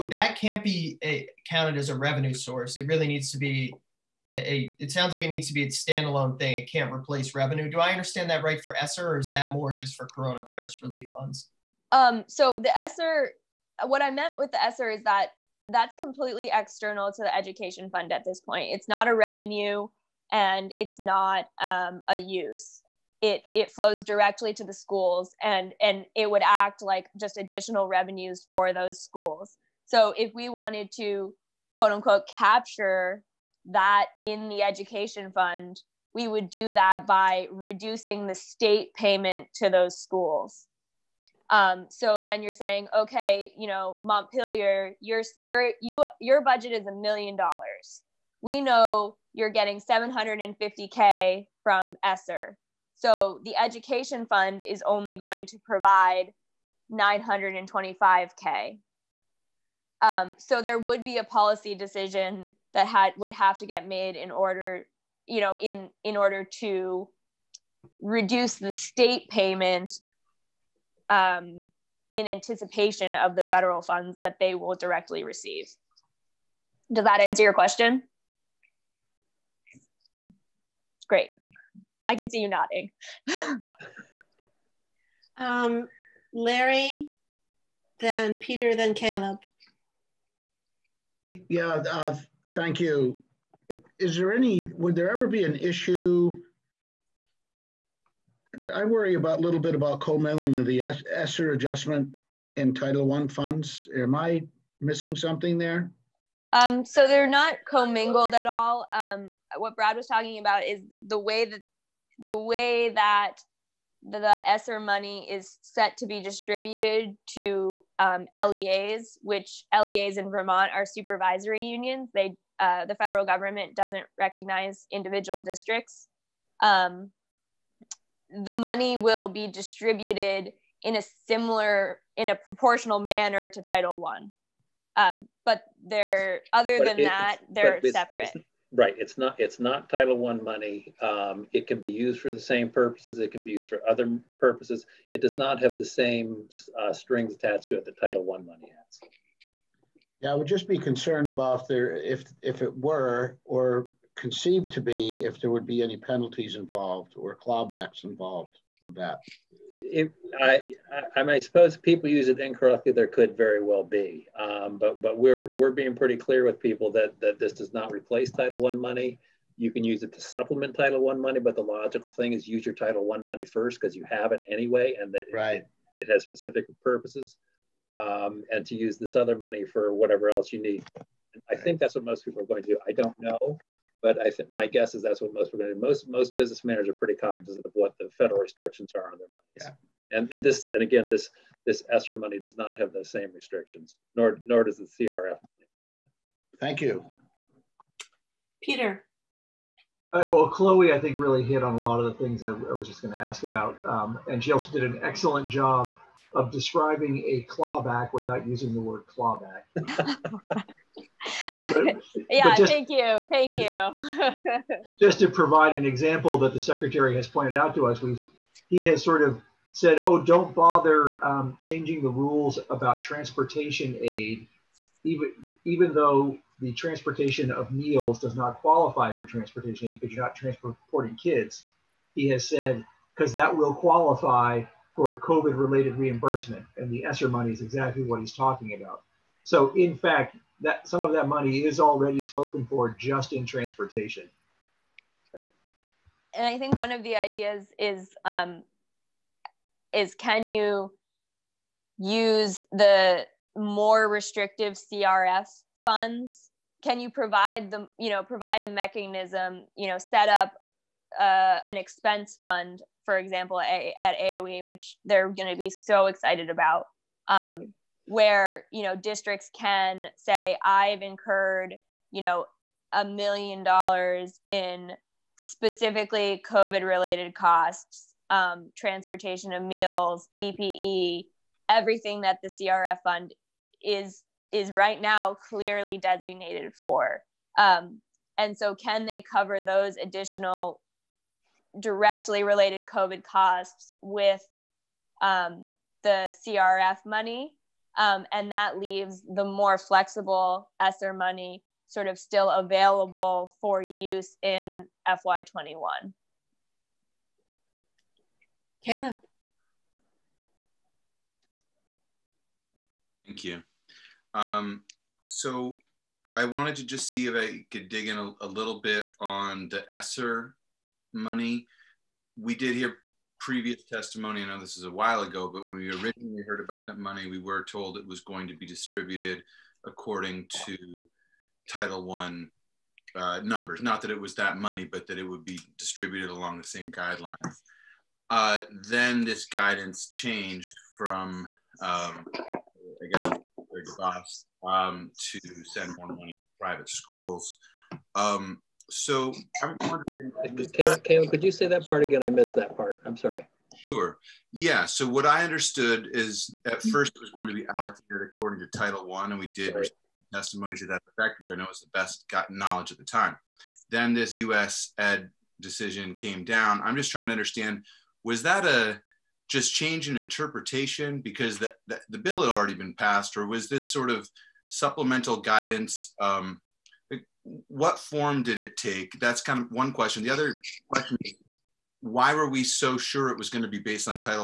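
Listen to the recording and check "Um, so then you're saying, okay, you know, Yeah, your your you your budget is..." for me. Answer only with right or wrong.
wrong.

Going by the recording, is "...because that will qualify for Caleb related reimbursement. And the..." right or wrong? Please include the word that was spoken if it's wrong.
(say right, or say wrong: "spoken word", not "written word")
wrong: "COVID", not "Caleb".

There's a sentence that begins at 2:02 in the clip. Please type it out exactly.
They, uh, the federal government doesn't recognize individual districts.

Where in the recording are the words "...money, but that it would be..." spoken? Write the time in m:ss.
5:34.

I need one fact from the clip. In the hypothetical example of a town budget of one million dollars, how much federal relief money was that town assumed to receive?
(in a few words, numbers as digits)
750k.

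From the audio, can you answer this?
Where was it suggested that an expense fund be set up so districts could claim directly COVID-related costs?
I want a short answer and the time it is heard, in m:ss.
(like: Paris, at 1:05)
AOE, at 4:24.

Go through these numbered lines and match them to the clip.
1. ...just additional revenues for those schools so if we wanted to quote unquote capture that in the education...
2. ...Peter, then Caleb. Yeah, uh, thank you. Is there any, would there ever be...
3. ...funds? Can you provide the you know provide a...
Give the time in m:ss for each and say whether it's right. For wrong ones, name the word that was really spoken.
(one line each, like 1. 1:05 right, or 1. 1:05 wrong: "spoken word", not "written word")
1. 0:27 right
2. 1:28 right
3. 4:15 right.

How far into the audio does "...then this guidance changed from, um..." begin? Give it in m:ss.
5:38.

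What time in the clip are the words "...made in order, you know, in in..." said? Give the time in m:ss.
1:03.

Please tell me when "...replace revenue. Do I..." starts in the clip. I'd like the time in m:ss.
0:06.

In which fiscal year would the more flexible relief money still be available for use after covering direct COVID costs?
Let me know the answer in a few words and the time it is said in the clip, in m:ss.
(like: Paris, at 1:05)
FY21, at 5:05.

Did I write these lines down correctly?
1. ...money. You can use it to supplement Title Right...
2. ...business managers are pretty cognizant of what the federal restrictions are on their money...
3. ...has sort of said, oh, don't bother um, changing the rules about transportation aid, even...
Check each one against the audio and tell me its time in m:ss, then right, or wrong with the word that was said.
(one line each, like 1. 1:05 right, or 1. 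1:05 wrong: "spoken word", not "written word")
1. 2:48 wrong: "One", not "Right"
2. 3:06 right
3. 3:38 right.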